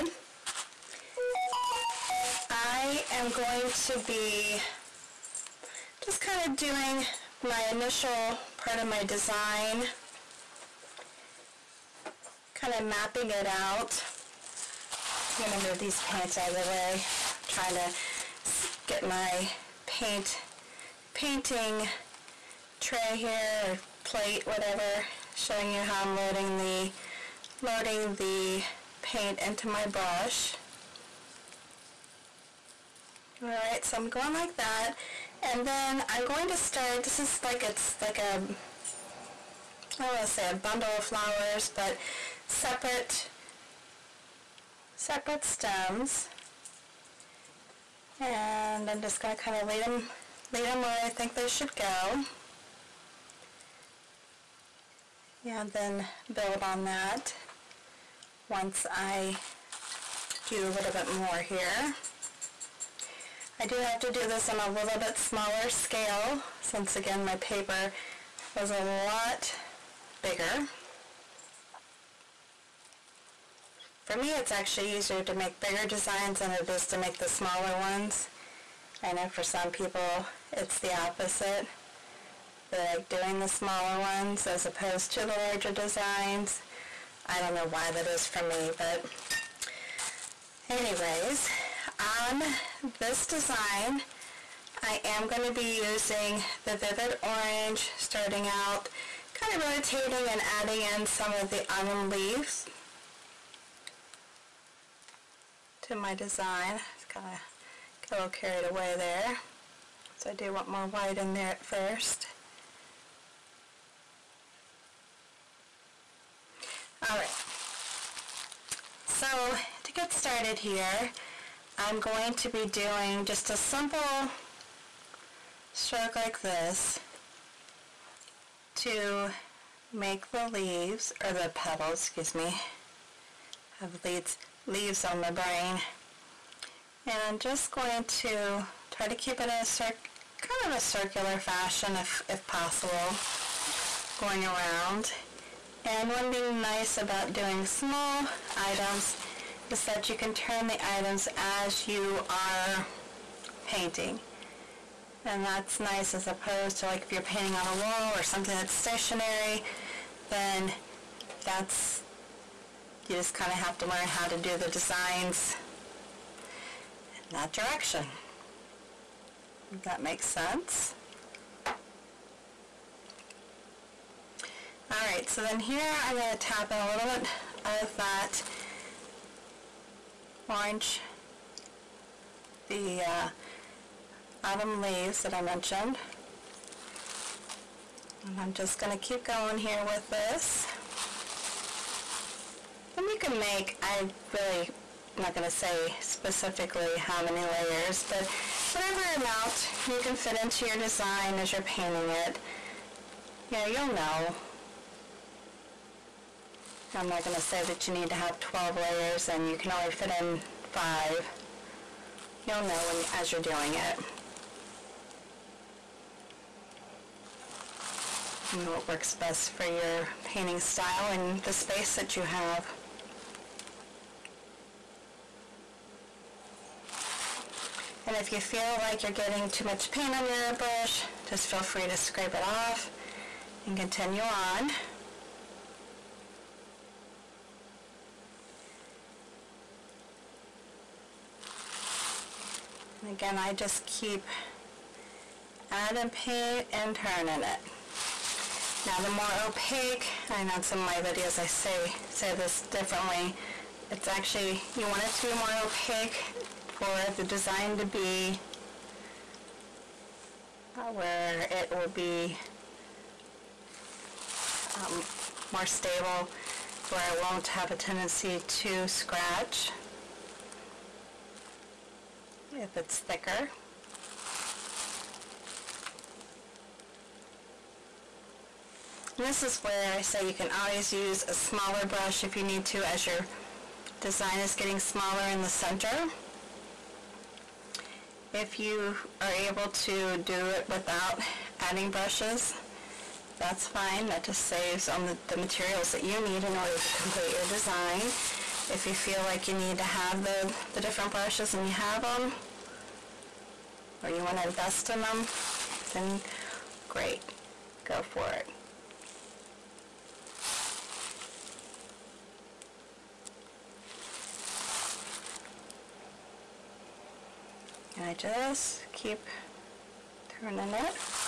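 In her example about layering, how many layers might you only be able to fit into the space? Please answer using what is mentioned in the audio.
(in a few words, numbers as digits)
5.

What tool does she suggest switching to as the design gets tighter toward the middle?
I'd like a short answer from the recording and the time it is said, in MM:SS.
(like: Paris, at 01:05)
A smaller brush, at 04:41.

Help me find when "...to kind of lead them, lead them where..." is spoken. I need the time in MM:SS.
00:49.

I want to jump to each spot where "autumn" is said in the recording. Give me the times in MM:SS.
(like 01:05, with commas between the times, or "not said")
01:41, 03:04.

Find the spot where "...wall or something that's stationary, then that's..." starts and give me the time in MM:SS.
02:37.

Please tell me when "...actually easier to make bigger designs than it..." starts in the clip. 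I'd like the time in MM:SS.
01:14.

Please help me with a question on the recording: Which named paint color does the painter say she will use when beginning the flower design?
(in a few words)
Vivid Orange.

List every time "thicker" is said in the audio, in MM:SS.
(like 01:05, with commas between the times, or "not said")
04:32.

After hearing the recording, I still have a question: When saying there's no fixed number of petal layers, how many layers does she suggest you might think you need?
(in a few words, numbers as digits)
12.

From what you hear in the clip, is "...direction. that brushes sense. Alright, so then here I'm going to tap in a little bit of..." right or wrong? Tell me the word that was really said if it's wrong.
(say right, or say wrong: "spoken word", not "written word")
wrong: "makes", not "brushes".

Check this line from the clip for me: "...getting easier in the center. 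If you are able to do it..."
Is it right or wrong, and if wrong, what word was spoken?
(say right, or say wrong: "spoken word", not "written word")
wrong: "smaller", not "easier".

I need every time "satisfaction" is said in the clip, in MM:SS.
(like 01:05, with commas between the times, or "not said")
not said.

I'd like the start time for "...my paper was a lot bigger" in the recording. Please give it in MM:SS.
01:07.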